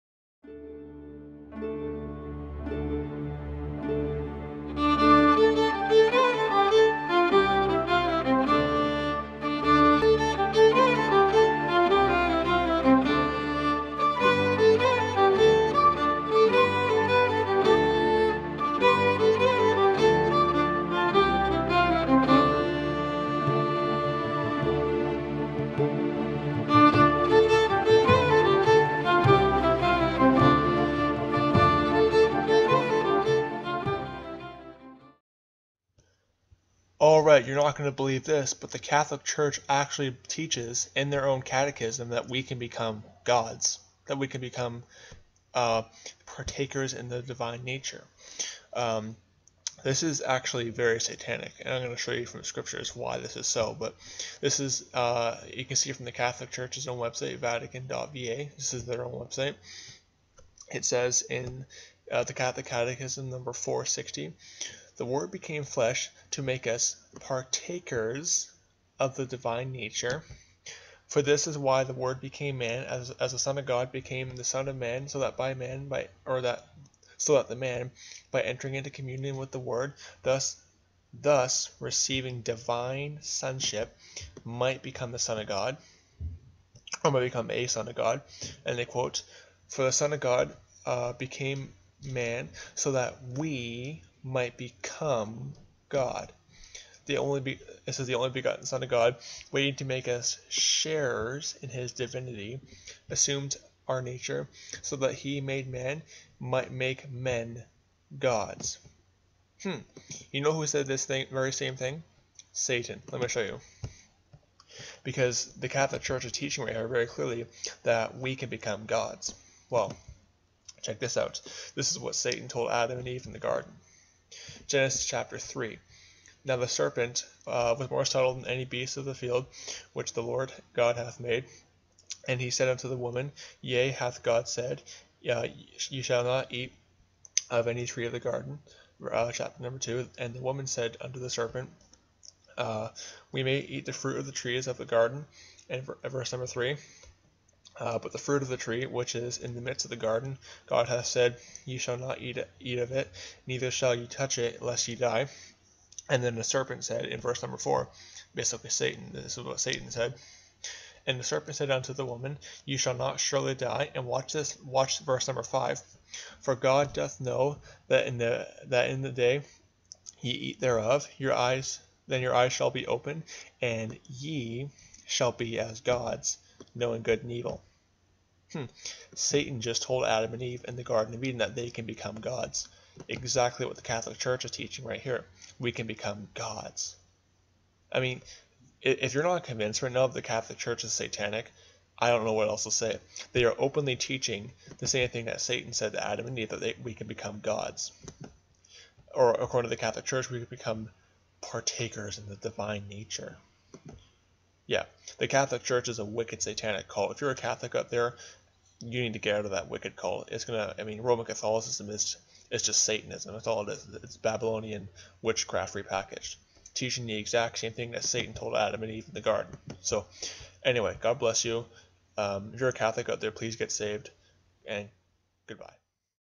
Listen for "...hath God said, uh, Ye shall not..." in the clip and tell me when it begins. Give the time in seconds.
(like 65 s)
133 s.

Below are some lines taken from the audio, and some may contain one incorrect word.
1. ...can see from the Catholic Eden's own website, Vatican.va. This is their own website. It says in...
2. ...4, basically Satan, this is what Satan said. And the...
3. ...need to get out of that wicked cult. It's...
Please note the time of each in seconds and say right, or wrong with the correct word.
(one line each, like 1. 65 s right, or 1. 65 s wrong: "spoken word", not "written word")
1. 55 s wrong: "Church", not "Eden"
2. 157 s right
3. 209 s right.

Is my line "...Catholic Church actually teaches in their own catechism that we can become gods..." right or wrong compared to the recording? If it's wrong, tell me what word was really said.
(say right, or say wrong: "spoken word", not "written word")
right.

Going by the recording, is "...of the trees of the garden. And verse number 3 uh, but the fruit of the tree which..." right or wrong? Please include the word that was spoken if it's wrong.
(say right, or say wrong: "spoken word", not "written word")
right.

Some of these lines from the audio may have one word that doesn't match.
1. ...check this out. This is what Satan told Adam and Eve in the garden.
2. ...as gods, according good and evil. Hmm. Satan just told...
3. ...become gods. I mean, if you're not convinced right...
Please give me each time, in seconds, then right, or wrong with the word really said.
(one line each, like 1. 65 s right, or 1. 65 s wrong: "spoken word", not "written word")
1. 120 s right
2. 175 s wrong: "knowing", not "according"
3. 185 s right.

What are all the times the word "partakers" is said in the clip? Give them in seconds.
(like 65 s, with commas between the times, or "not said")
46 s, 67 s, 201 s.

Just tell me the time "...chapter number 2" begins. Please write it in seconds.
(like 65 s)
139 s.